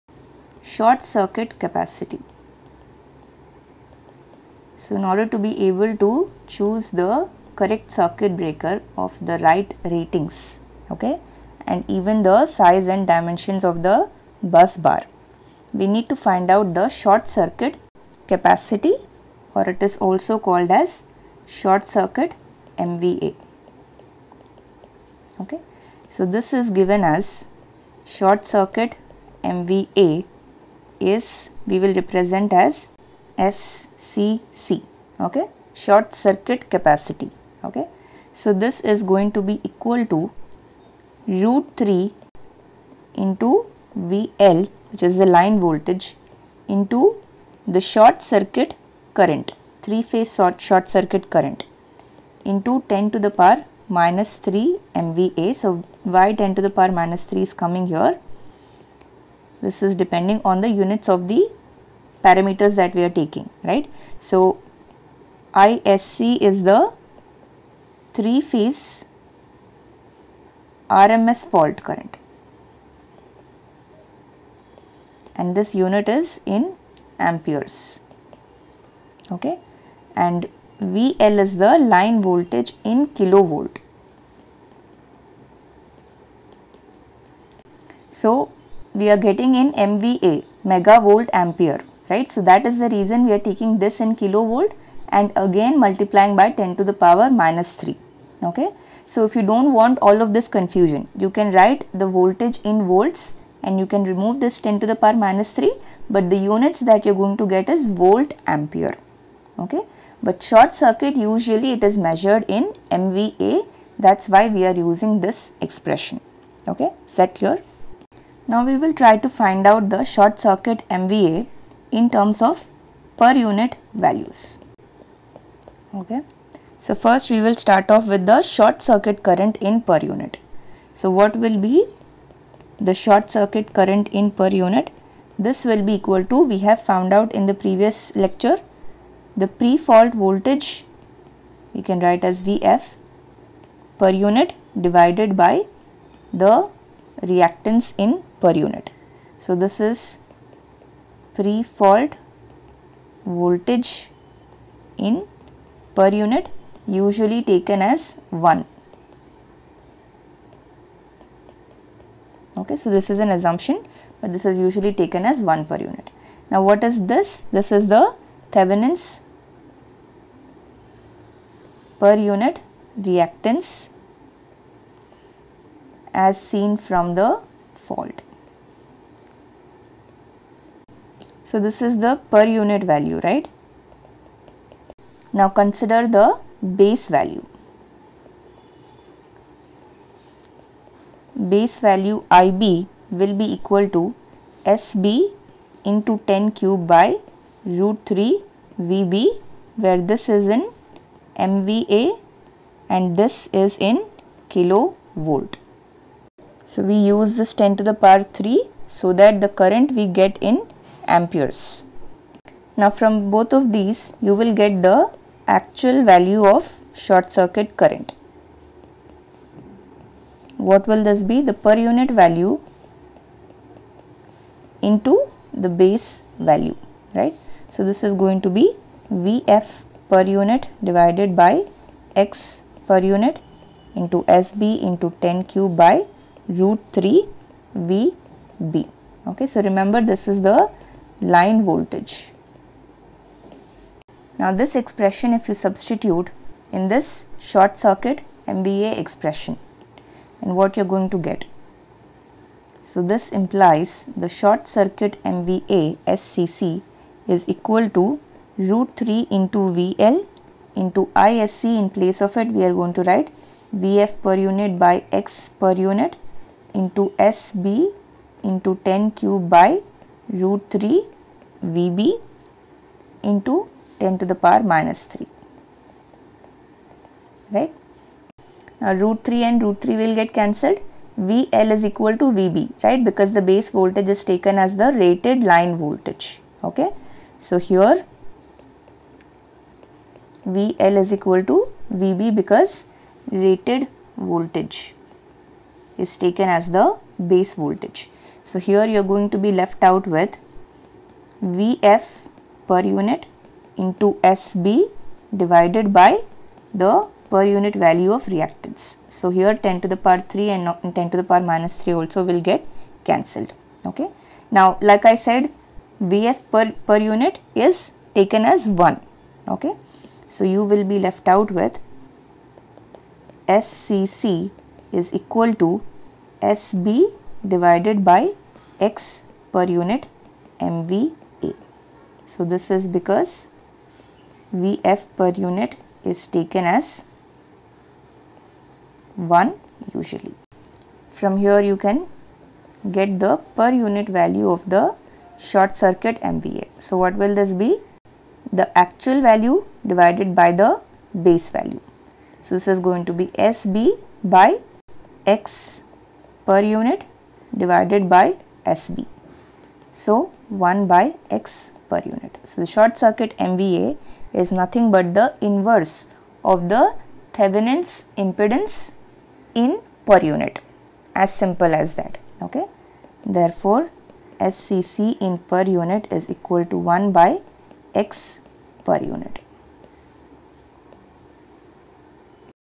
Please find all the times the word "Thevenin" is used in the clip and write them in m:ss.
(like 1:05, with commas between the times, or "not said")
2:48, 6:07.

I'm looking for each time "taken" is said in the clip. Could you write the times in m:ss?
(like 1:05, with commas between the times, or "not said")
2:37, 2:44, 4:44, 4:56, 5:18, 5:36.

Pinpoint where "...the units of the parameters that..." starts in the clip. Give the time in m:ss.
1:00.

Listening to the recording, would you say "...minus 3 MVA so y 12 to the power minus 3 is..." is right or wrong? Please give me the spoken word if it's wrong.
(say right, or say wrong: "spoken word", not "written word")
wrong: "10", not "12".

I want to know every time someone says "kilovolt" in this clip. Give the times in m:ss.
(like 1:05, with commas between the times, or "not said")
1:23, 1:34, 3:24.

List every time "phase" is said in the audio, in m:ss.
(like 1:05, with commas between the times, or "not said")
0:50, 1:08.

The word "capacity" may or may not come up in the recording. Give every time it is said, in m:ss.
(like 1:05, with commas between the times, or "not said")
0:01, 0:18, 0:36.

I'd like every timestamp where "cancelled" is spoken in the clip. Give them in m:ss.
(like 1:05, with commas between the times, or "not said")
4:40, 5:13.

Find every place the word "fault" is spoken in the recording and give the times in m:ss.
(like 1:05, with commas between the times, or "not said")
1:11, 2:19, 2:31, 2:57.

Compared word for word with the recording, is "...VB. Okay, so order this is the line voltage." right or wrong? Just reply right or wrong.
wrong.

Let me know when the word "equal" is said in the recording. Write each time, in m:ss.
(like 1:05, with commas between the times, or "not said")
0:39, 2:16, 3:13, 4:17, 4:41, 4:51, 5:25, 6:16.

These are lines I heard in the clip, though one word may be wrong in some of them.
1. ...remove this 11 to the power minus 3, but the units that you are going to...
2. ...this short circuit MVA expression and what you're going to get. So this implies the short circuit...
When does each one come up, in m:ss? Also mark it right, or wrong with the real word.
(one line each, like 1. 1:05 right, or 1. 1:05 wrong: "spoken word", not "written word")
1. 1:44 wrong: "10", not "11"
2. 4:06 right.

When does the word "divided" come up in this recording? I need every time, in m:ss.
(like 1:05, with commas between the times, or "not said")
2:24, 3:50, 5:05, 5:27, 5:49, 5:57.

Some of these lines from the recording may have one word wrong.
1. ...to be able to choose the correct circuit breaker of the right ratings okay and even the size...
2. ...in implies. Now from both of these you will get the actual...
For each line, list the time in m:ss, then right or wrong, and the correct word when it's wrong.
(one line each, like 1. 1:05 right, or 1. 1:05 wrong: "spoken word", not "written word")
1. 0:05 right
2. 3:30 wrong: "amperes", not "implies".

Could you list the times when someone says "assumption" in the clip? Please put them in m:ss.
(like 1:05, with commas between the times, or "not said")
2:43.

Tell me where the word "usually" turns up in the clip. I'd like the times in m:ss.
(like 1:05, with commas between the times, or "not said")
1:51, 2:36, 2:44, 5:39.